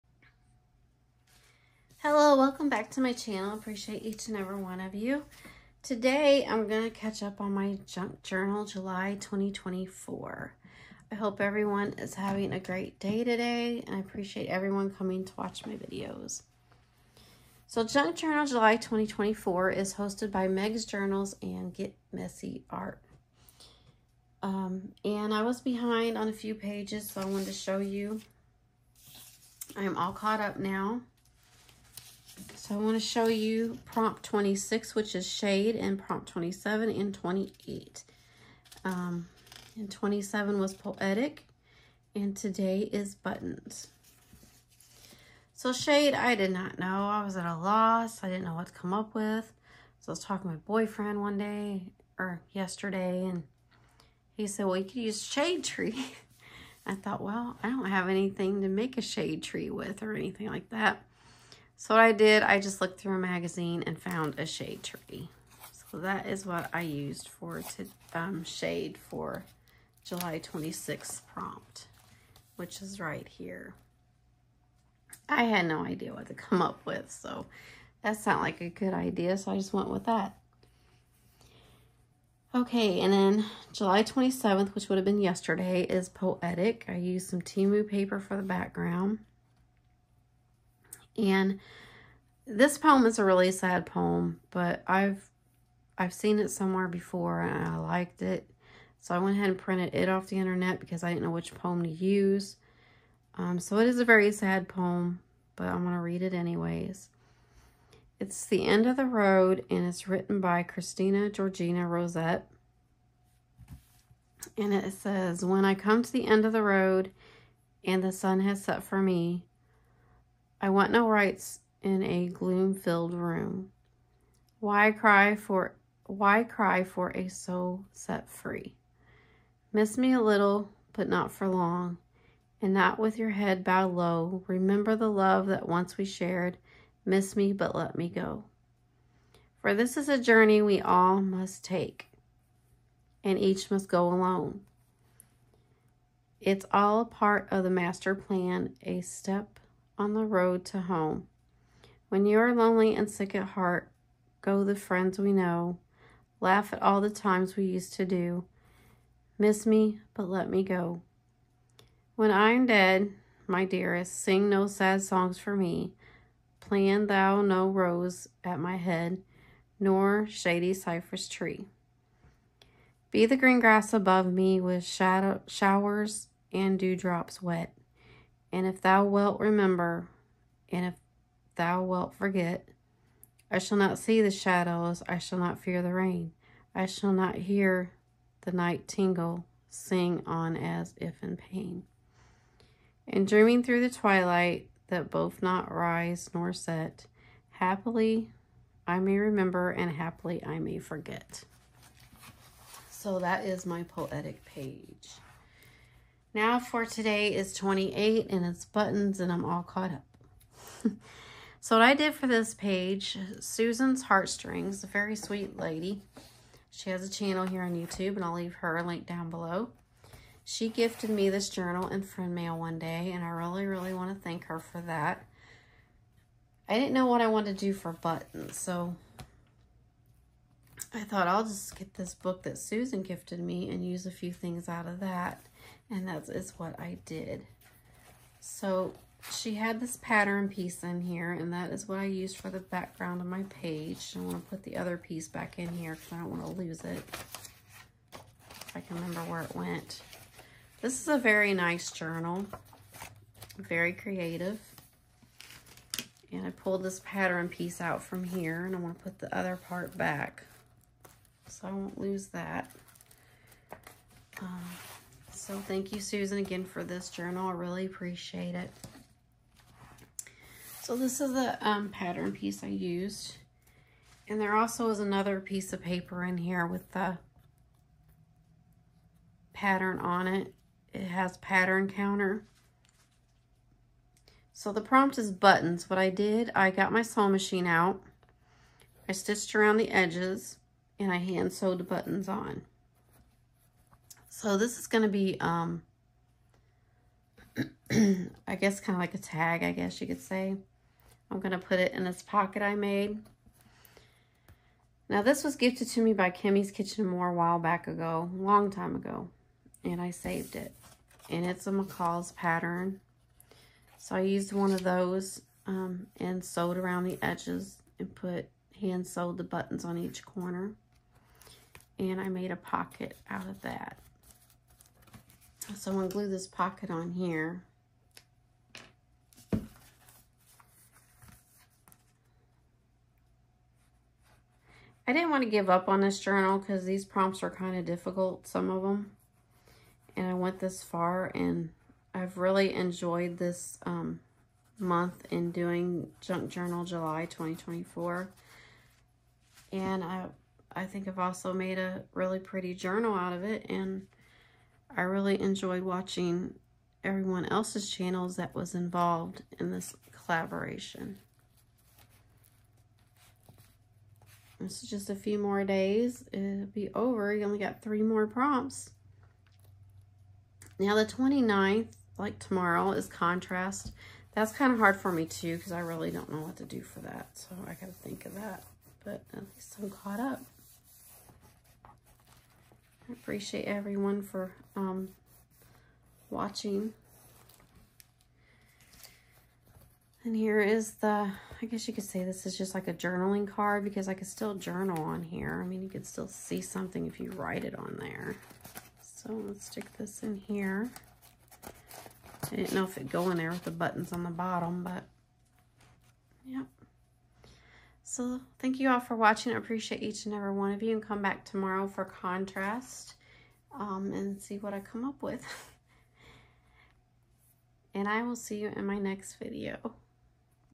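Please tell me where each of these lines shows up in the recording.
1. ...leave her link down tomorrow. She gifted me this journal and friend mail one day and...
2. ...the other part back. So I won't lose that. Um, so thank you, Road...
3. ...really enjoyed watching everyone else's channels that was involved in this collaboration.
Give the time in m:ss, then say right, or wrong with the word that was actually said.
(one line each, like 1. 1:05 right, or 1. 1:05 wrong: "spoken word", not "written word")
1. 3:38 wrong: "below", not "tomorrow"
2. 4:19 wrong: "Susan", not "Road"
3. 5:55 right.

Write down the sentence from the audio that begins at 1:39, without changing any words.
So I went ahead and printed it off the internet because I didn't know which poem to use.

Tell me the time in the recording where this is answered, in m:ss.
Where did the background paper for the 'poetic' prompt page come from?
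1:27.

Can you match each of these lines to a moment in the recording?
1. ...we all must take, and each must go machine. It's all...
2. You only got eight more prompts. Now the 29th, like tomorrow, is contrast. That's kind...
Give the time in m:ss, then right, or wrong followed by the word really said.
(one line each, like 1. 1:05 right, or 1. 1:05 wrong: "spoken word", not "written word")
1. 2:20 wrong: "alone", not "machine"
2. 6:07 wrong: "three", not "eight".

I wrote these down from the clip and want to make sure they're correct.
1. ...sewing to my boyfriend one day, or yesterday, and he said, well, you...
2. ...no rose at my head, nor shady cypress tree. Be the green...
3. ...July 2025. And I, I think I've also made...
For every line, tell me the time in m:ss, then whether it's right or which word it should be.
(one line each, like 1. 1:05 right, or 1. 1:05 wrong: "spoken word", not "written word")
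1. 0:50 wrong: "talking", not "sewing"
2. 2:47 right
3. 5:46 wrong: "2024", not "2025".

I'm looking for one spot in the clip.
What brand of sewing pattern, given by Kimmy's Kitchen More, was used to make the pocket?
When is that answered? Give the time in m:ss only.
5:11.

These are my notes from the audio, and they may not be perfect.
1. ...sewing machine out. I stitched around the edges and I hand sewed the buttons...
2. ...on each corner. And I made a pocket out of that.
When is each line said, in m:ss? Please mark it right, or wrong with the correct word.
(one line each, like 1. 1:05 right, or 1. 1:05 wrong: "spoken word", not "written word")
1. 4:47 right
2. 5:19 right.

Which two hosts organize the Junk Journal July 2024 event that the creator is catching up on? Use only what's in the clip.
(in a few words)
Meg's Journals and Get Messy Art.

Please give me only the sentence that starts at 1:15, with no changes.
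I had no idea what to come up with, so that's not like a good idea, so I just went with that.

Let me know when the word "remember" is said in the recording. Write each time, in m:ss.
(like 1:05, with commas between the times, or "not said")
2:14, 2:59, 3:19, 4:08.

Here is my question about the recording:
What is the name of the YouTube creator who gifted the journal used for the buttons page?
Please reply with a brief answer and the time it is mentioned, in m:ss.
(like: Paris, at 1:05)
Susan's Heartstrings, at 3:33.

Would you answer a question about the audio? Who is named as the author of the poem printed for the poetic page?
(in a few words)
Christina Georgina Rossetti.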